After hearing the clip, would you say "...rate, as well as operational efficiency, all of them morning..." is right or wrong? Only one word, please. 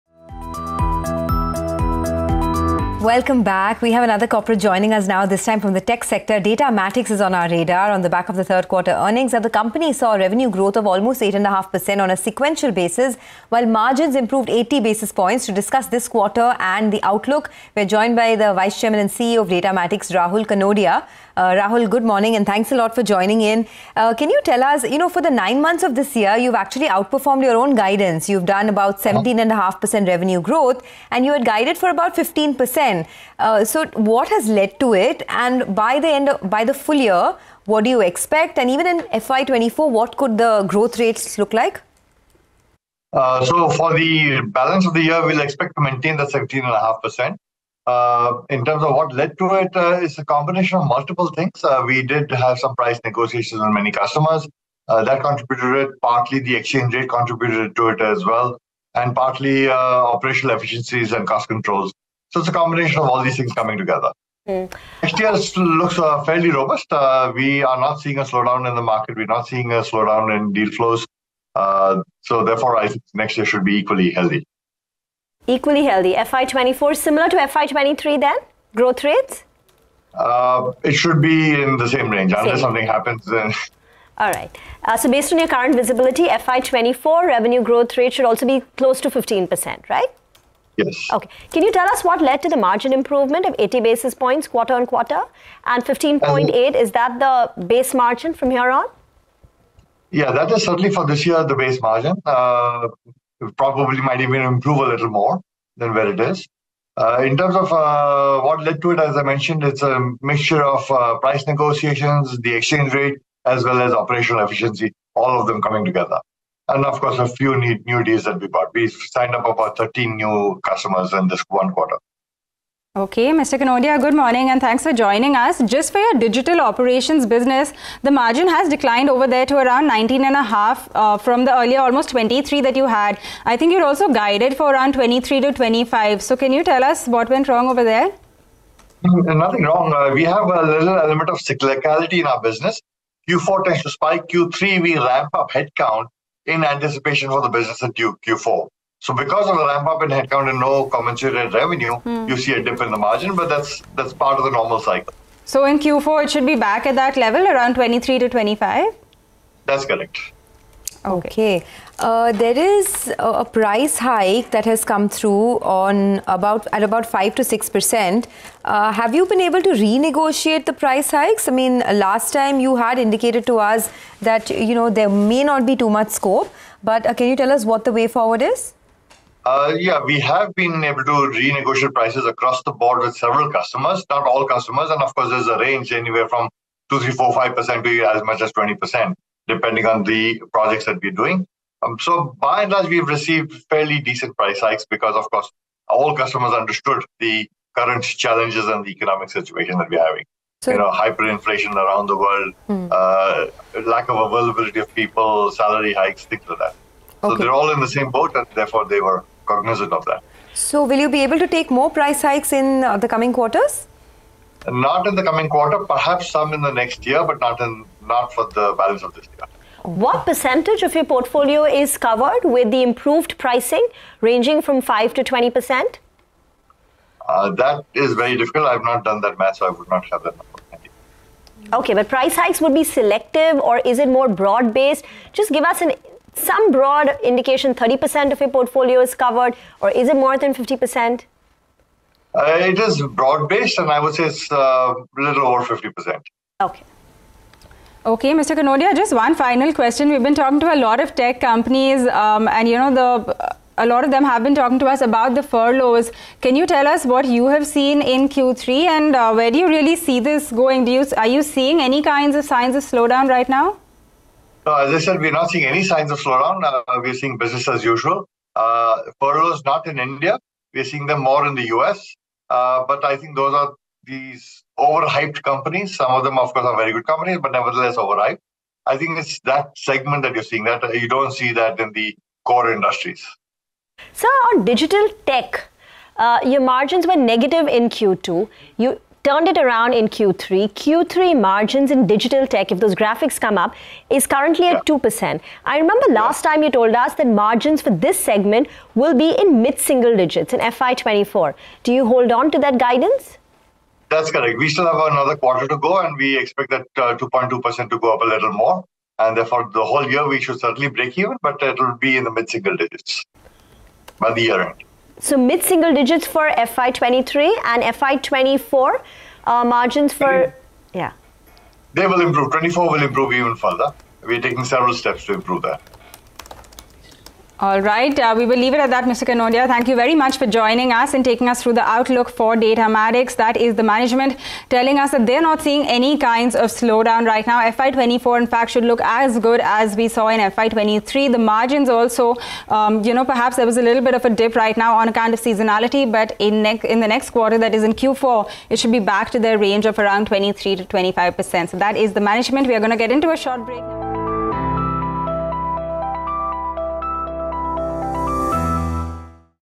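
wrong.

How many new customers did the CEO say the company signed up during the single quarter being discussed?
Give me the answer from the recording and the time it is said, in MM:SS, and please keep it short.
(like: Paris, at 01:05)
13, at 01:59.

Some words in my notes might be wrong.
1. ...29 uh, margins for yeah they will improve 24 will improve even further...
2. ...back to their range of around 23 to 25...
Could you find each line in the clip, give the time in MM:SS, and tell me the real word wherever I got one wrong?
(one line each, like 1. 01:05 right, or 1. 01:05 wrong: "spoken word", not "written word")
1. 05:18 wrong: "24", not "29"
2. 05:48 right.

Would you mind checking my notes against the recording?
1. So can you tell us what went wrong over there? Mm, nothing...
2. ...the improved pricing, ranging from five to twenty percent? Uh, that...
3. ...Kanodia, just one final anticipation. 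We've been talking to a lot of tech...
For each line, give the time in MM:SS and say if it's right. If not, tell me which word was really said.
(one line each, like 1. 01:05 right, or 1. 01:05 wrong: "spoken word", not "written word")
1. 02:16 right
2. 03:42 right
3. 04:08 wrong: "question", not "anticipation".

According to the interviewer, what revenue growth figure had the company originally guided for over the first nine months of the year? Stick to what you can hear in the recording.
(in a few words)
15%.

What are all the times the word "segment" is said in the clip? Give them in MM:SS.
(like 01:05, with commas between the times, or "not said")
04:39, 04:58.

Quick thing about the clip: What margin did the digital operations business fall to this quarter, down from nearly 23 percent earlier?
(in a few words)
19.5%.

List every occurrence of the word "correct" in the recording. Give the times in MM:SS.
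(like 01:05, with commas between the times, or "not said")
02:39, 05:04.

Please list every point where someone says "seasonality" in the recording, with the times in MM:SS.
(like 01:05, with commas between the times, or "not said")
05:45.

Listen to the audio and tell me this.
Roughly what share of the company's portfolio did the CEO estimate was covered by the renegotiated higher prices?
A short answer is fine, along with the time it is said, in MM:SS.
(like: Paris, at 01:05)
little over 50%, at 04:05.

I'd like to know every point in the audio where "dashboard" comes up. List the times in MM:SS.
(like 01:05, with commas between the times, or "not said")
not said.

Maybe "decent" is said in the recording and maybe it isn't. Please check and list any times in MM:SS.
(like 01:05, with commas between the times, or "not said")
03:13.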